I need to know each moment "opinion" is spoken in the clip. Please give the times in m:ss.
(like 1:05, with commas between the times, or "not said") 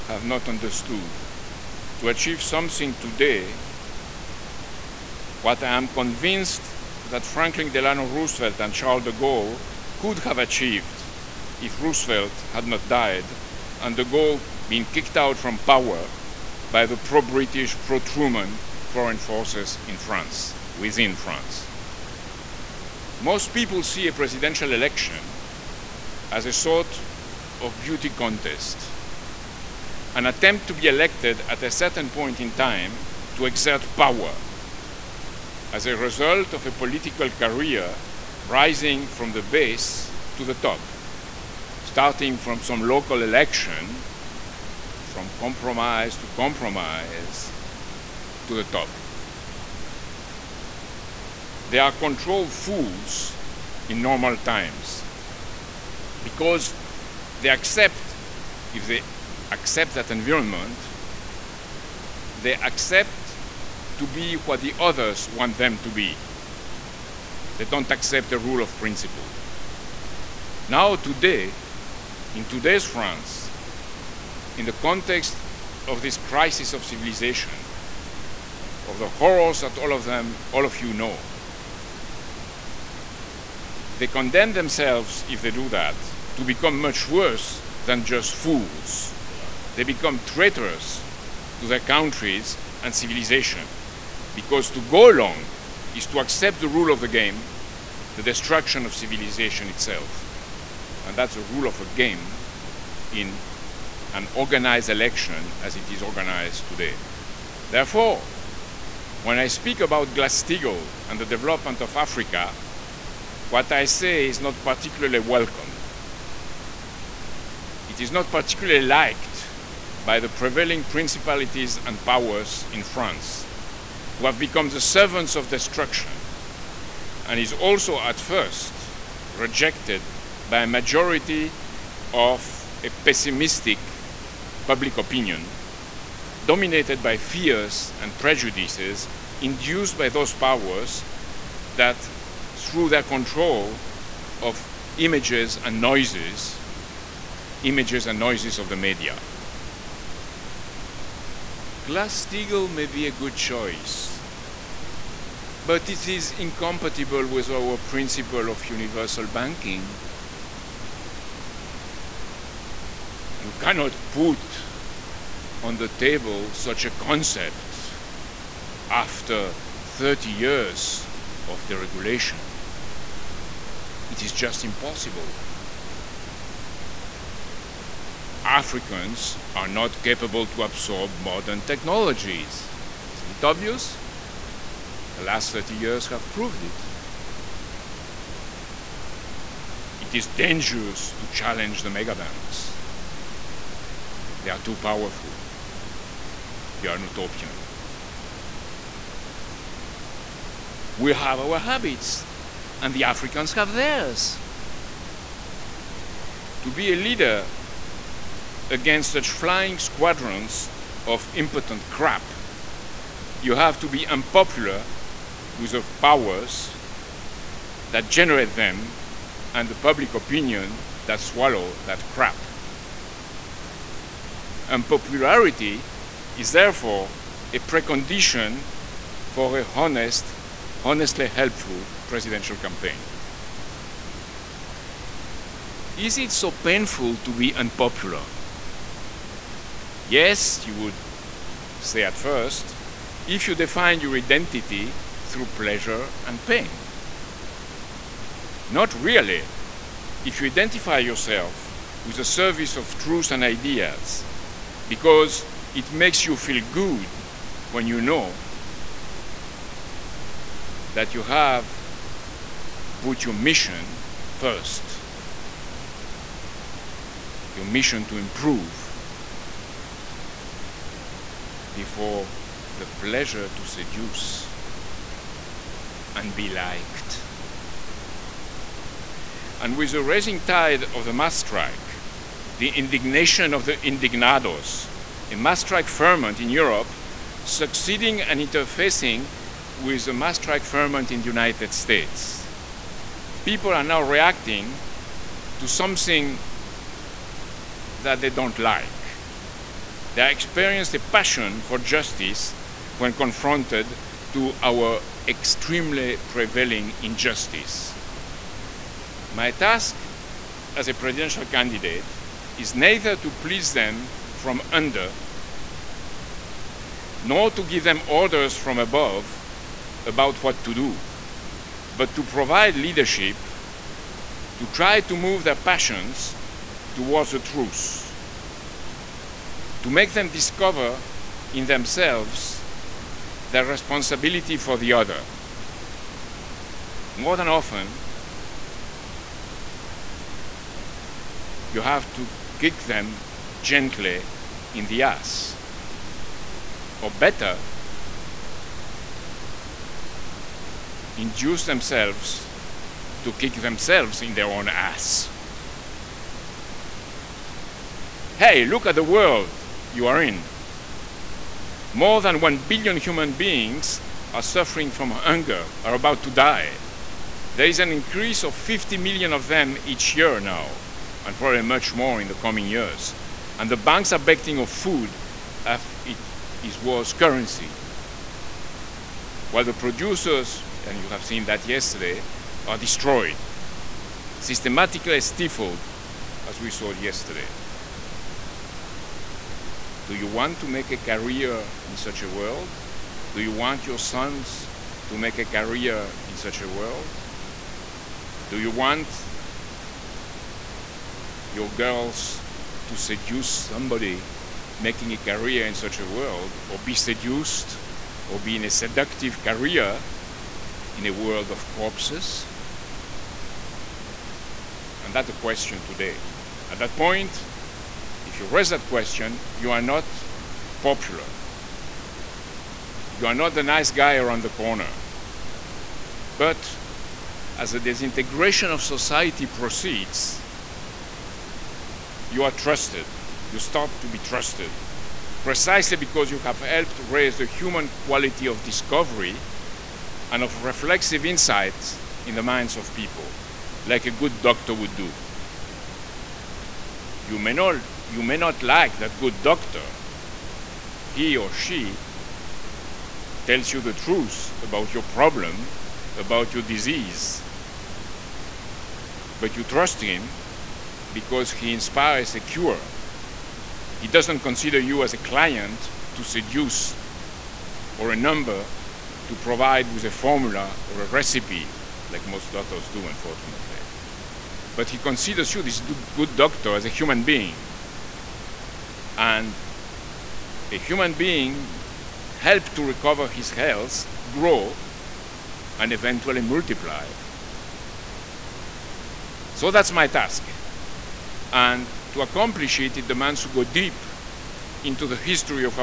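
2:14, 3:40.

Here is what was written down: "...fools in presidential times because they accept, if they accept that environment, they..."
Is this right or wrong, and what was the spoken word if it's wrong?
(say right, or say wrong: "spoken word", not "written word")
wrong: "normal", not "presidential".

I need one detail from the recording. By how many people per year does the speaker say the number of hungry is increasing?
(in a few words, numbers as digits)
50 million.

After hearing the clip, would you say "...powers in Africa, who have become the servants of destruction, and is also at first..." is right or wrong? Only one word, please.
wrong.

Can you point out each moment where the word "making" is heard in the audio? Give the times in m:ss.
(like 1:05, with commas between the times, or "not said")
6:44.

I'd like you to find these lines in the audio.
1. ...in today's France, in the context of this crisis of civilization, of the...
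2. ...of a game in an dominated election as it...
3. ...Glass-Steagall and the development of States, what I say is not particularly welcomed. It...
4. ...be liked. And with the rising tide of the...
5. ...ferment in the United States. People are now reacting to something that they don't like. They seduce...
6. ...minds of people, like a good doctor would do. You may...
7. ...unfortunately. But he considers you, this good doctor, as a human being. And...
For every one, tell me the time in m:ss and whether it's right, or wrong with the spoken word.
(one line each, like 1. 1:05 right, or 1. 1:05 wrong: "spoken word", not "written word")
1. 1:12 right
2. 1:41 wrong: "organized", not "dominated"
3. 1:50 wrong: "Africa", not "States"
4. 4:36 right
5. 4:50 wrong: "experience", not "seduce"
6. 7:22 right
7. 7:53 right.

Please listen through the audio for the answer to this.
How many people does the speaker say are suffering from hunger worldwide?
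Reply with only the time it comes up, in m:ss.
6:01.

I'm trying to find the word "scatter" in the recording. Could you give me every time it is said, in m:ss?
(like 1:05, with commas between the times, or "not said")
not said.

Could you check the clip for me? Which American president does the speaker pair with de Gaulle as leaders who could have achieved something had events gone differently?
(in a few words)
Franklin Delano Roosevelt.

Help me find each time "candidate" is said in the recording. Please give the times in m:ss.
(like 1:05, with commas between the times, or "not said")
5:11.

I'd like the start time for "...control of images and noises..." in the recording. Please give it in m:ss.
2:23.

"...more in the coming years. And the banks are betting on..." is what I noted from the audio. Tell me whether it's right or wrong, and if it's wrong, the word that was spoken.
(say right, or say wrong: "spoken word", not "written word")
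right.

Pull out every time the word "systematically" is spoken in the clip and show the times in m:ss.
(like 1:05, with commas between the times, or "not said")
6:24.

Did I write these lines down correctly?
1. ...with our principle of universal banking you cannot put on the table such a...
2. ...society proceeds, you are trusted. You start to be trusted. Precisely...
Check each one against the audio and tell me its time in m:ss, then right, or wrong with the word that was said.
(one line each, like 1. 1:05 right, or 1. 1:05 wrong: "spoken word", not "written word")
1. 2:37 right
2. 7:08 right.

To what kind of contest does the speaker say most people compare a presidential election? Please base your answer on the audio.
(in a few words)
Beauty contest.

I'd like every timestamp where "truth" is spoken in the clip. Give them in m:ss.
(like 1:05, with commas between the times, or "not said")
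4:12, 5:27, 7:33.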